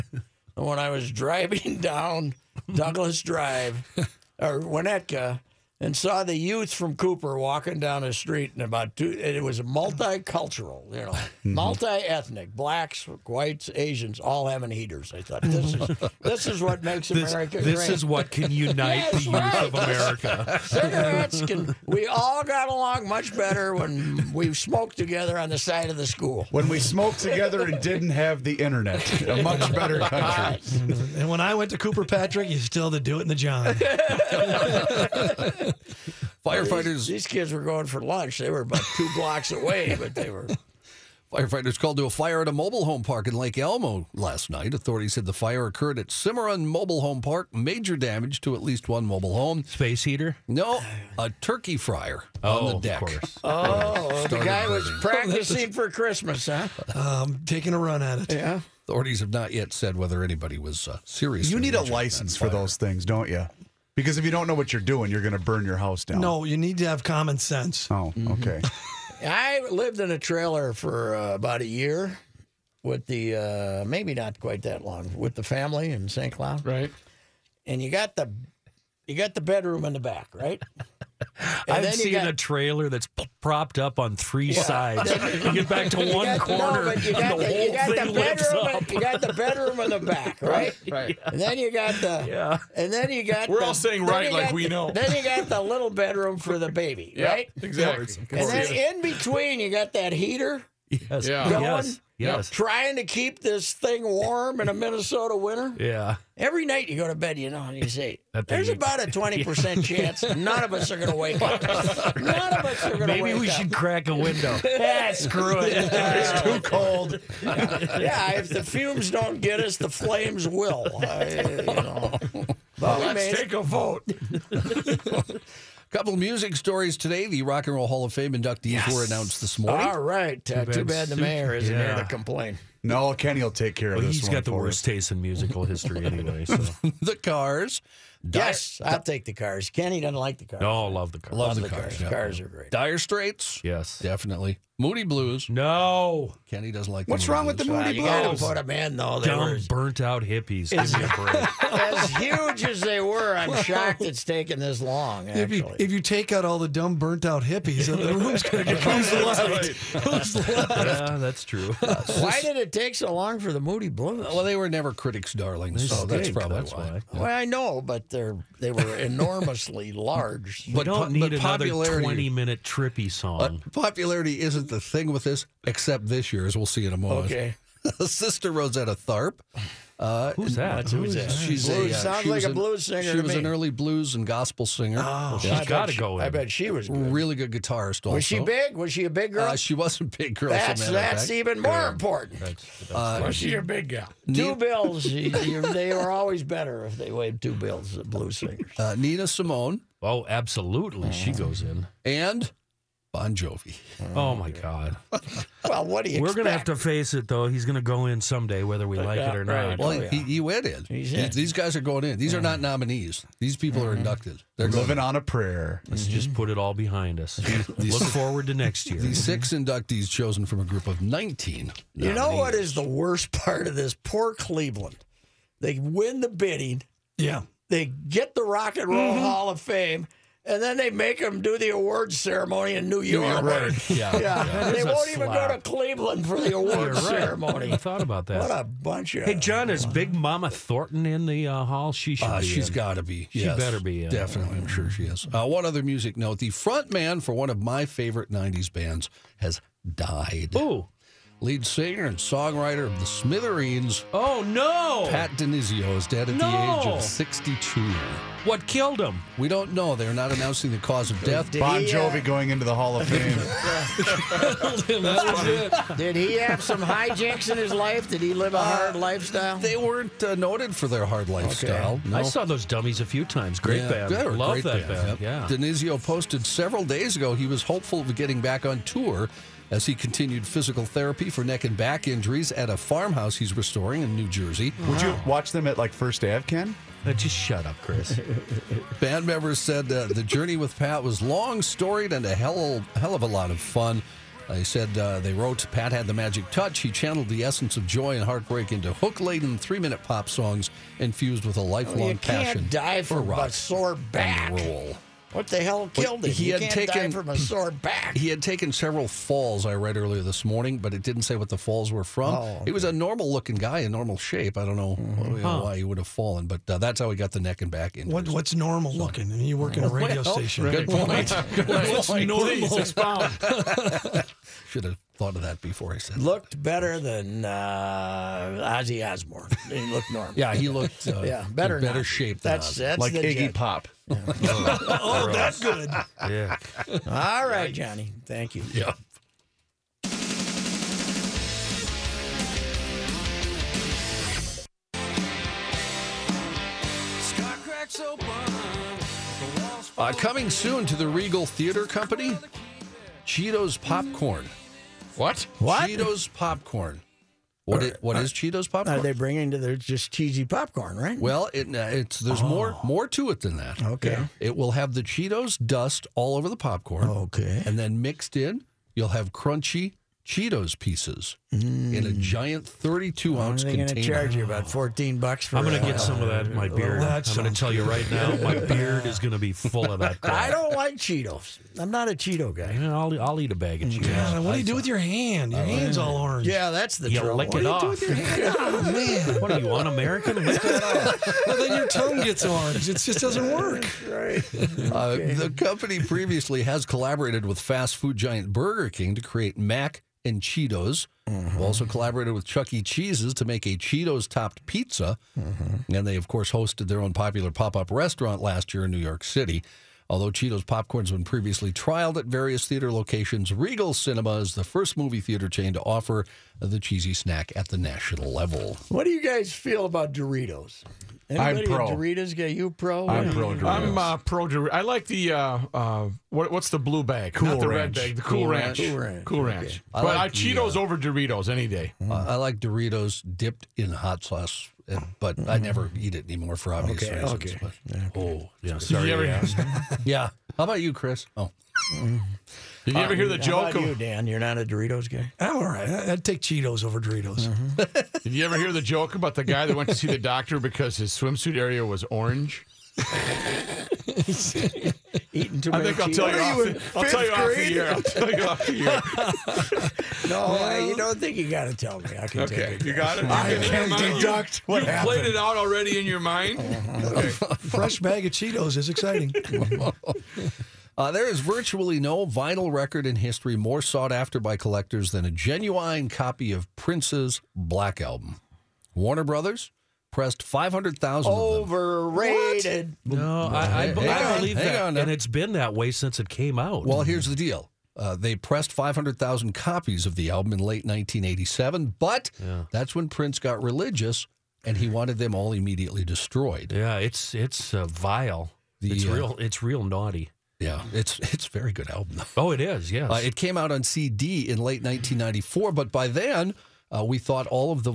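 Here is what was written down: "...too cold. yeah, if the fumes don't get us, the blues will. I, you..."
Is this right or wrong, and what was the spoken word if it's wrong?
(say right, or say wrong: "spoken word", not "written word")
wrong: "flames", not "blues".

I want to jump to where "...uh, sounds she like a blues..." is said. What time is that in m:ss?
3:01.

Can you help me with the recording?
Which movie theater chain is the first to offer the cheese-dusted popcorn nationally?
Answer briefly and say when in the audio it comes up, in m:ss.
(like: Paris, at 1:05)
Regal Cinema, at 6:53.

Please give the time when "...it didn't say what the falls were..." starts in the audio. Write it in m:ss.
5:10.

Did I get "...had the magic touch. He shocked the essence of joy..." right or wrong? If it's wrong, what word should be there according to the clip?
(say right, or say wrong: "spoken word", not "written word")
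wrong: "channeled", not "shocked".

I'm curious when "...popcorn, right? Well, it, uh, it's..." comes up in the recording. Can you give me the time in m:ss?
6:00.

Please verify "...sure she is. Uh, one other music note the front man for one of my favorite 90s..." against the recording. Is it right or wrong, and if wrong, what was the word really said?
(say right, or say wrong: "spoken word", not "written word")
right.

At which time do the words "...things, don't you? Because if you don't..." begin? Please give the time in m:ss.
1:02.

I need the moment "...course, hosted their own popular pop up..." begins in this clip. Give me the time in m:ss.
6:46.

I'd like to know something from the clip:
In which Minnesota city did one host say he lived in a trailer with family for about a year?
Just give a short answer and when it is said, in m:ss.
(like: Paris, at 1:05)
St. Cloud, at 1:16.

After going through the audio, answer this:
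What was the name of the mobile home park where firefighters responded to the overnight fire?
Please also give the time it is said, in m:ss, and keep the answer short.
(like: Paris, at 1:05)
Cimarron Mobile Home Park, at 0:46.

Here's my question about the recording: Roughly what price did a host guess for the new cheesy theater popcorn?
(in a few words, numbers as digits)
$14.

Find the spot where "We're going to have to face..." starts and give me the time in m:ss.
3:26.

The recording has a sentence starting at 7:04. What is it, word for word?
I like the uh, uh, what, what's the blue bag?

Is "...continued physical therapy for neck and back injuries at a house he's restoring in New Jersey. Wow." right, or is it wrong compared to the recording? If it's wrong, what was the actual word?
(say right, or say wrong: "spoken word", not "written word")
wrong: "farmhouse", not "house".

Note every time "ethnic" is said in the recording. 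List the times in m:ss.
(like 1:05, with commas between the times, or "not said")
0:11.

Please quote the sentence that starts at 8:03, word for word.
No, I, I, b- Hang I believe that.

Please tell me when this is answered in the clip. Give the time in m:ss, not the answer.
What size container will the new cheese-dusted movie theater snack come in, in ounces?
6:12.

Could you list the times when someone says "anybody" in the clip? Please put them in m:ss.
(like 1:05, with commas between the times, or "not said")
1:00, 7:01.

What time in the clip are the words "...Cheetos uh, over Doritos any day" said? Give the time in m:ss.
7:10.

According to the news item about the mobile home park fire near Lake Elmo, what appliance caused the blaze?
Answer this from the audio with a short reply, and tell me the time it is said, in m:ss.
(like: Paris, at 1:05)
turkey fryer, at 0:51.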